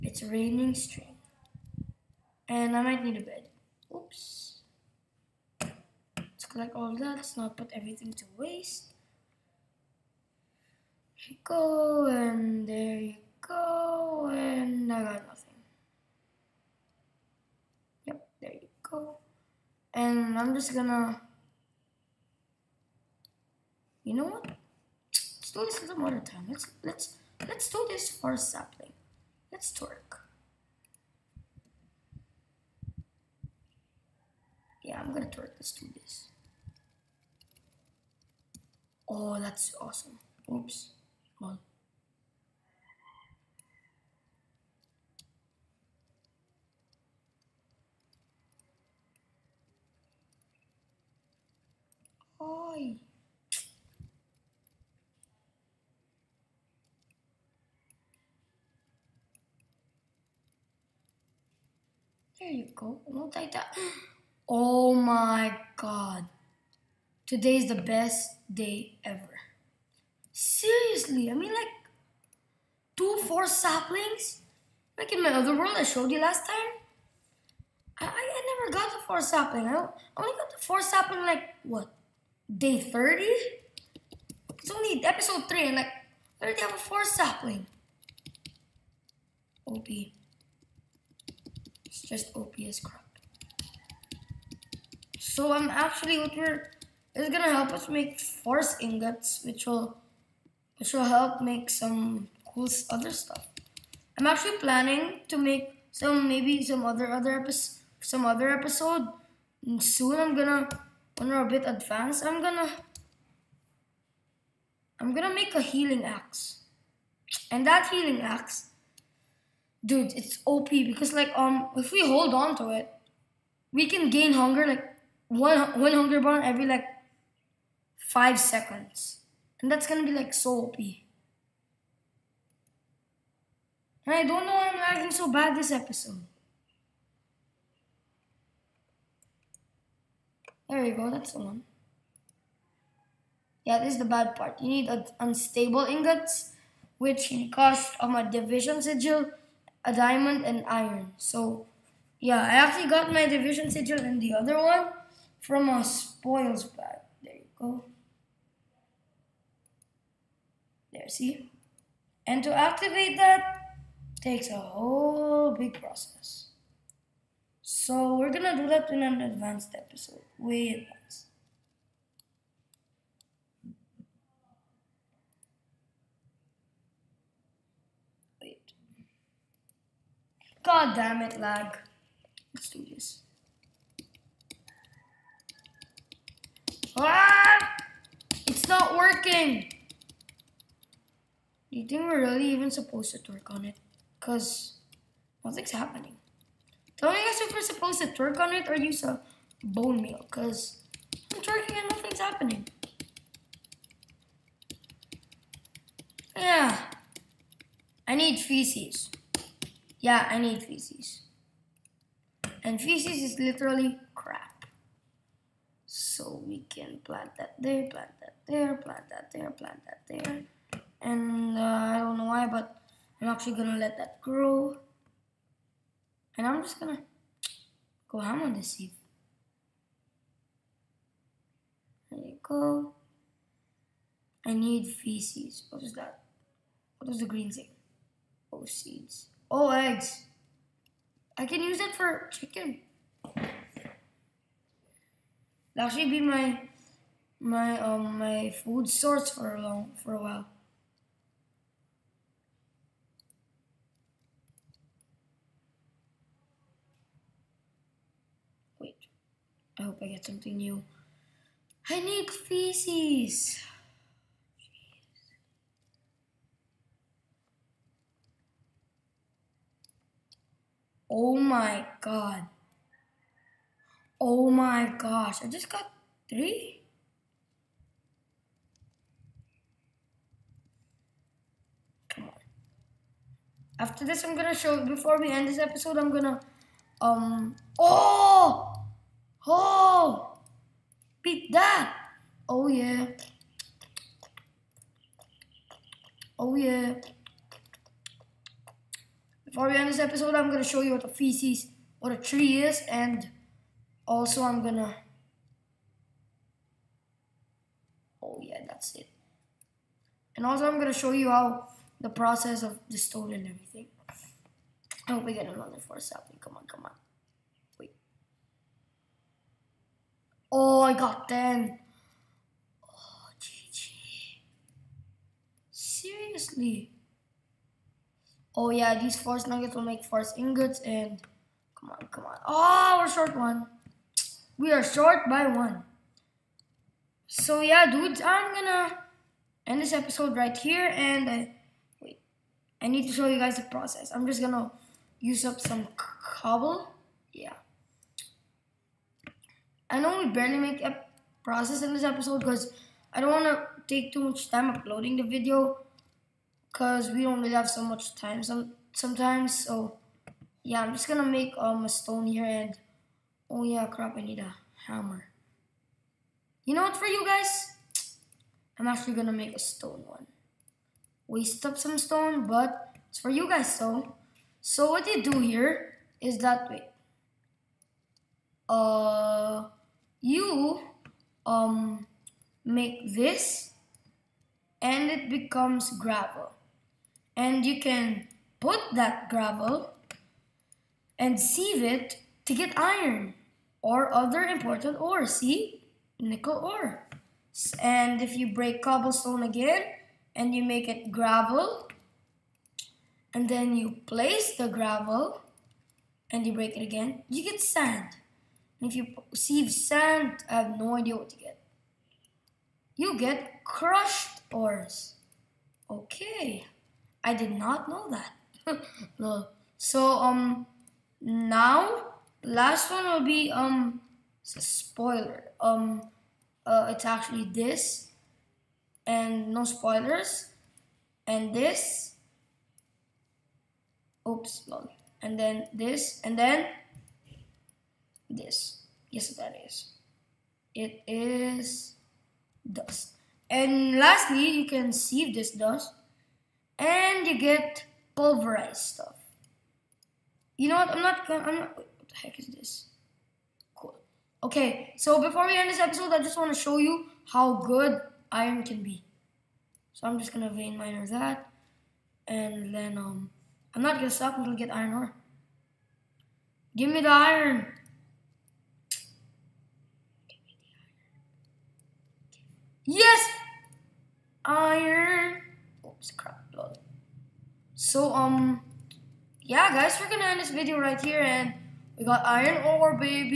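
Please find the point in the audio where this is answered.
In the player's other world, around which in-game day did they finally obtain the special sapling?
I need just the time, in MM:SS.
01:22.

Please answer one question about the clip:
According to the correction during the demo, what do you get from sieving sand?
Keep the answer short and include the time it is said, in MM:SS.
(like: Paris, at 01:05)
crushed ores, at 06:53.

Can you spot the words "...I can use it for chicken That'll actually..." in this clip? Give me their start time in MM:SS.
04:01.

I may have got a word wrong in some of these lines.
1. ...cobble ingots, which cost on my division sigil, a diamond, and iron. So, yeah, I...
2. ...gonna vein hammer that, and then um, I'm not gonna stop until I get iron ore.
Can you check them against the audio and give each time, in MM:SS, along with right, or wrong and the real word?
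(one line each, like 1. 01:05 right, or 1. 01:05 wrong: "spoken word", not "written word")
1. 02:25 wrong: "unstable", not "cobble"
2. 07:40 wrong: "miner", not "hammer".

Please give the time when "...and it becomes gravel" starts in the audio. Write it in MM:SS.
06:24.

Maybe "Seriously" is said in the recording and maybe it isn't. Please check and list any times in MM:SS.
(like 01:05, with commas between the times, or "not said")
01:10, 05:25.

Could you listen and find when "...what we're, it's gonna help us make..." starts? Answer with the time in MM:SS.
01:36.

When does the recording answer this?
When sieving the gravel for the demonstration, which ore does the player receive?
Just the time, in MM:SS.
06:36.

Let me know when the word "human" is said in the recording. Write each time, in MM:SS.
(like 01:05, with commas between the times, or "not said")
not said.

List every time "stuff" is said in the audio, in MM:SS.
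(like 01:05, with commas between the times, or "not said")
01:43, 07:28.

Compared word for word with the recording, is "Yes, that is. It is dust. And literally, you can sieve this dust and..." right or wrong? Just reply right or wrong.
wrong.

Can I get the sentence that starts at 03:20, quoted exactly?
Because I'm twerking and nothing's happening.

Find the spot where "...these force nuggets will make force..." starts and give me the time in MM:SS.
05:29.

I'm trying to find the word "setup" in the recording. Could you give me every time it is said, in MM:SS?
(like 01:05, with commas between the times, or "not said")
not said.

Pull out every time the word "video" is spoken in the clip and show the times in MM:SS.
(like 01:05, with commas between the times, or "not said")
05:55, 08:00.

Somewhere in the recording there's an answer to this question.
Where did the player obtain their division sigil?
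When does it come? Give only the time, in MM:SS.
02:35.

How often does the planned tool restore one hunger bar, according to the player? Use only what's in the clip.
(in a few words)
every 5 seconds.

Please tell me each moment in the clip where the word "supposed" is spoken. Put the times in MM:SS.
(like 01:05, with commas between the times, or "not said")
03:12, 03:17.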